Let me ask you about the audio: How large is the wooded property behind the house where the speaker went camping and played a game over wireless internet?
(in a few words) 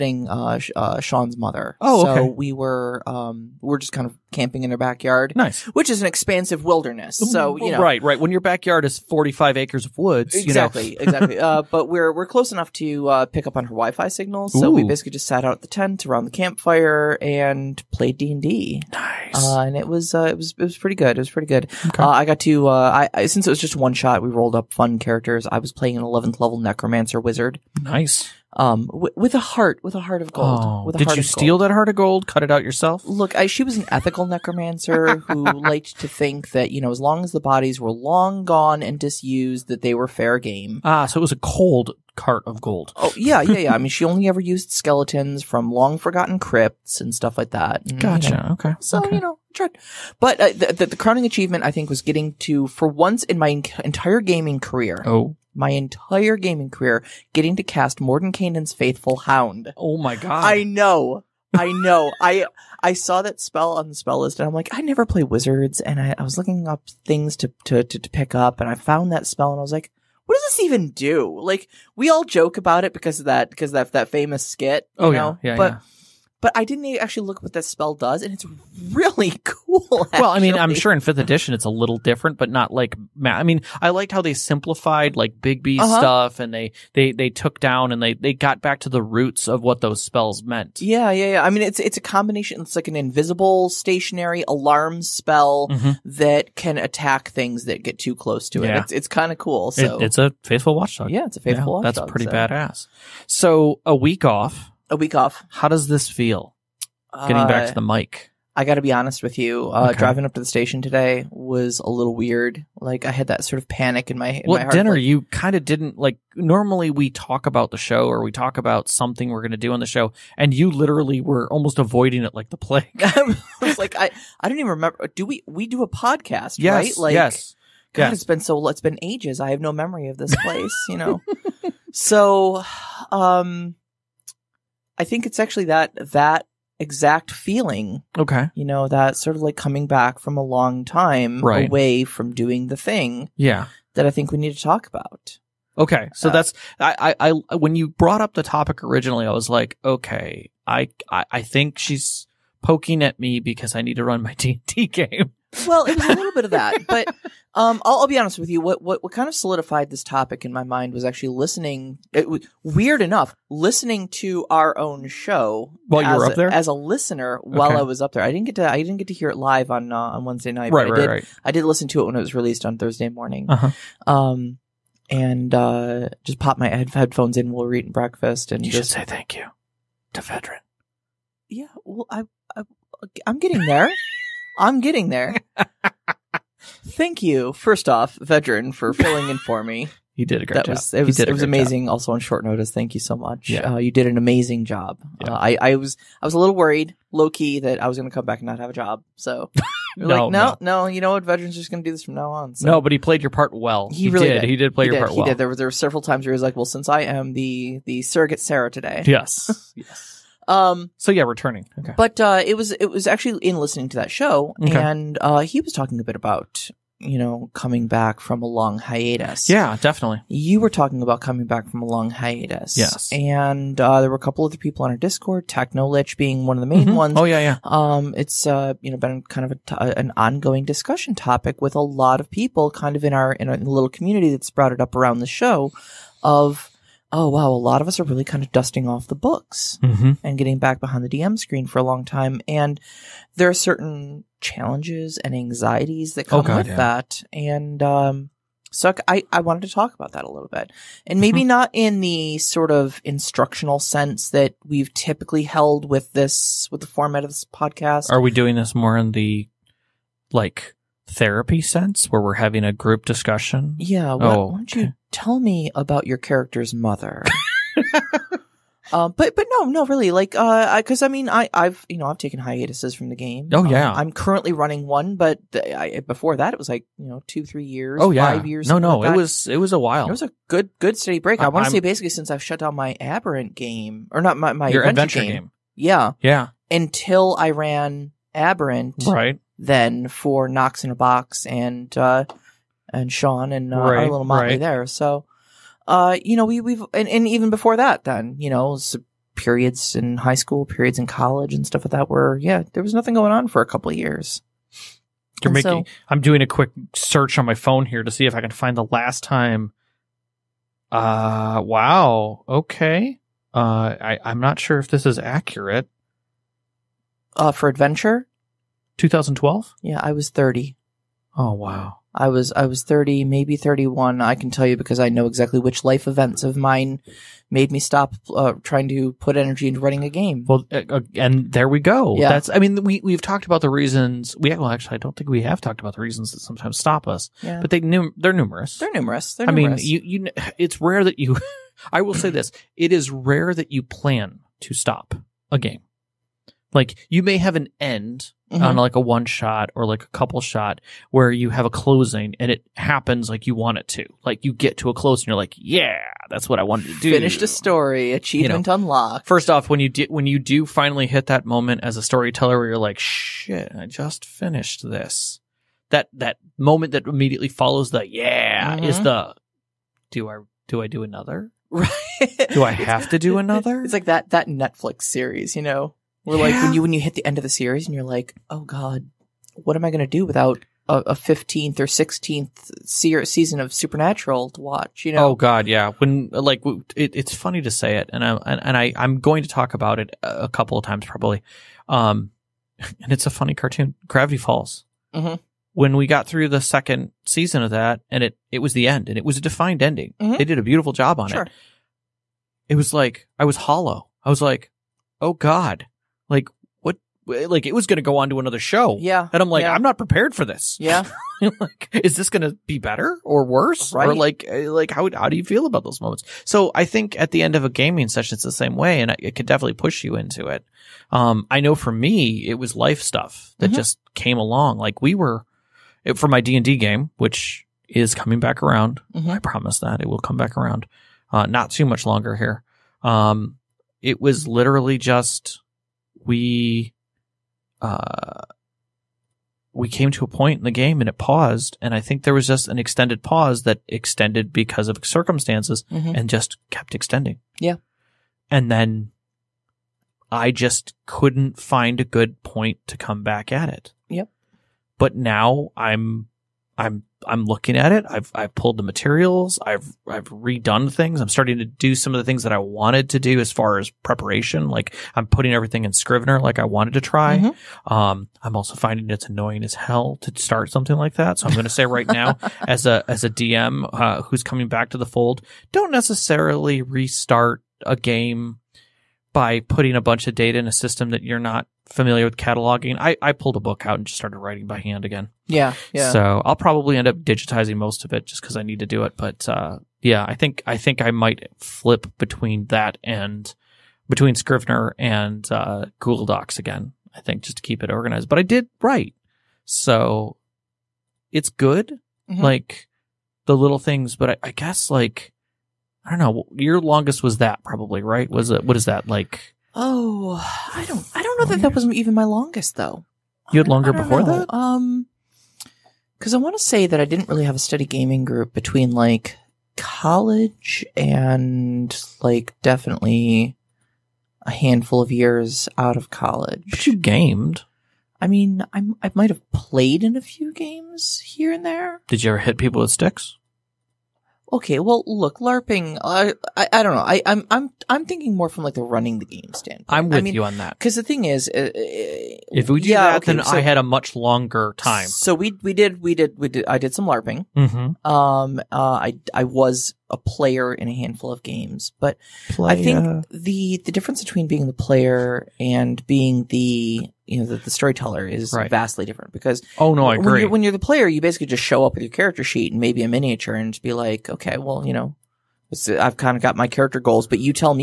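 45 acres.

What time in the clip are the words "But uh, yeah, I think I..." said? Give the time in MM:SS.
08:09.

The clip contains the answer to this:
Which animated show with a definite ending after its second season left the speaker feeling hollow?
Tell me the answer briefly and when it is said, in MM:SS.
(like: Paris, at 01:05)
Gravity Falls, at 06:34.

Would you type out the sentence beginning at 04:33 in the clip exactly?
Oh um, yeah, um, I'm currently running one, but I, before that it was like you know two three years.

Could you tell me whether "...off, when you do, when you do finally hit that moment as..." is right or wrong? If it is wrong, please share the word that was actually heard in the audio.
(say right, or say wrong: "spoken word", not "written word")
right.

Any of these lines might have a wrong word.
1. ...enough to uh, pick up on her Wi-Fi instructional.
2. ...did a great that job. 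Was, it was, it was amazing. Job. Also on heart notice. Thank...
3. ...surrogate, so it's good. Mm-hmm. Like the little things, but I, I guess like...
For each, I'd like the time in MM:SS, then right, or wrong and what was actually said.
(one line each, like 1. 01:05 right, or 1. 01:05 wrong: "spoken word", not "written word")
1. 00:12 wrong: "signal", not "instructional"
2. 03:10 wrong: "short", not "heart"
3. 08:18 wrong: "write", not "surrogate".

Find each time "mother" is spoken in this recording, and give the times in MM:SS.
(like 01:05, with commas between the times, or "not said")
00:01, 04:26.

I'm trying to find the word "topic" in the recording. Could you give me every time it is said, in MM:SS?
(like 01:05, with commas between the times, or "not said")
02:28, 02:40, 03:51.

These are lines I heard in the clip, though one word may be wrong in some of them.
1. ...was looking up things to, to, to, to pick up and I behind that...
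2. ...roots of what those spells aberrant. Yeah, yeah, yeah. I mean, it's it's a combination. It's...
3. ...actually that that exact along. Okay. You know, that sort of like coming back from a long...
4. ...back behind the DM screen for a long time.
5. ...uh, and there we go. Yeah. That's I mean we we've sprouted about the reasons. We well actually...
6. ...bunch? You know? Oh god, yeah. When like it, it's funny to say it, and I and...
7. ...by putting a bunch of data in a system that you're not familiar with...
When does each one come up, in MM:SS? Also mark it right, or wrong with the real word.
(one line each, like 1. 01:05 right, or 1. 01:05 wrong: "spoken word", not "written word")
1. 01:06 wrong: "found", not "behind"
2. 01:29 wrong: "meant", not "aberrant"
3. 02:15 wrong: "feeling", not "along"
4. 04:00 right
5. 05:30 wrong: "talked", not "sprouted"
6. 06:24 wrong: "watch", not "bunch"
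7. 07:59 right.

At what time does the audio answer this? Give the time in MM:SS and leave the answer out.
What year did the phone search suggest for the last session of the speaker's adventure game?
05:18.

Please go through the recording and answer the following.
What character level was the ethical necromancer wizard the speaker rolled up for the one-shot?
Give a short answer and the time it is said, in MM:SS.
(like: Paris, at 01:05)
11th, at 00:26.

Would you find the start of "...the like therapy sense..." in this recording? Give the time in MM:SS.
04:19.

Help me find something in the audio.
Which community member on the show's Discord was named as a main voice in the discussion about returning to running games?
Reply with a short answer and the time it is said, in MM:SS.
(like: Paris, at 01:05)
Technolich, at 03:45.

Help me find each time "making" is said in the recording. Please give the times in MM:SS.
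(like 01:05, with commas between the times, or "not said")
05:05.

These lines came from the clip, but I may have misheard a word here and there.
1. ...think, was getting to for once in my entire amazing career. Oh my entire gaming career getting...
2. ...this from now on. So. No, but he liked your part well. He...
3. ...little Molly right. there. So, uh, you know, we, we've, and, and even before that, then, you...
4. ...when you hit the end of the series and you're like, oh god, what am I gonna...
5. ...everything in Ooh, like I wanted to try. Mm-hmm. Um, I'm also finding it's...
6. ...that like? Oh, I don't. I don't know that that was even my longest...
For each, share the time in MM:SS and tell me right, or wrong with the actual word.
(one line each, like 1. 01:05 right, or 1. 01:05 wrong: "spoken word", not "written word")
1. 00:51 wrong: "gaming", not "amazing"
2. 03:21 wrong: "played", not "liked"
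3. 04:54 right
4. 06:16 right
5. 07:45 wrong: "Scrivener", not "Ooh"
6. 08:28 right.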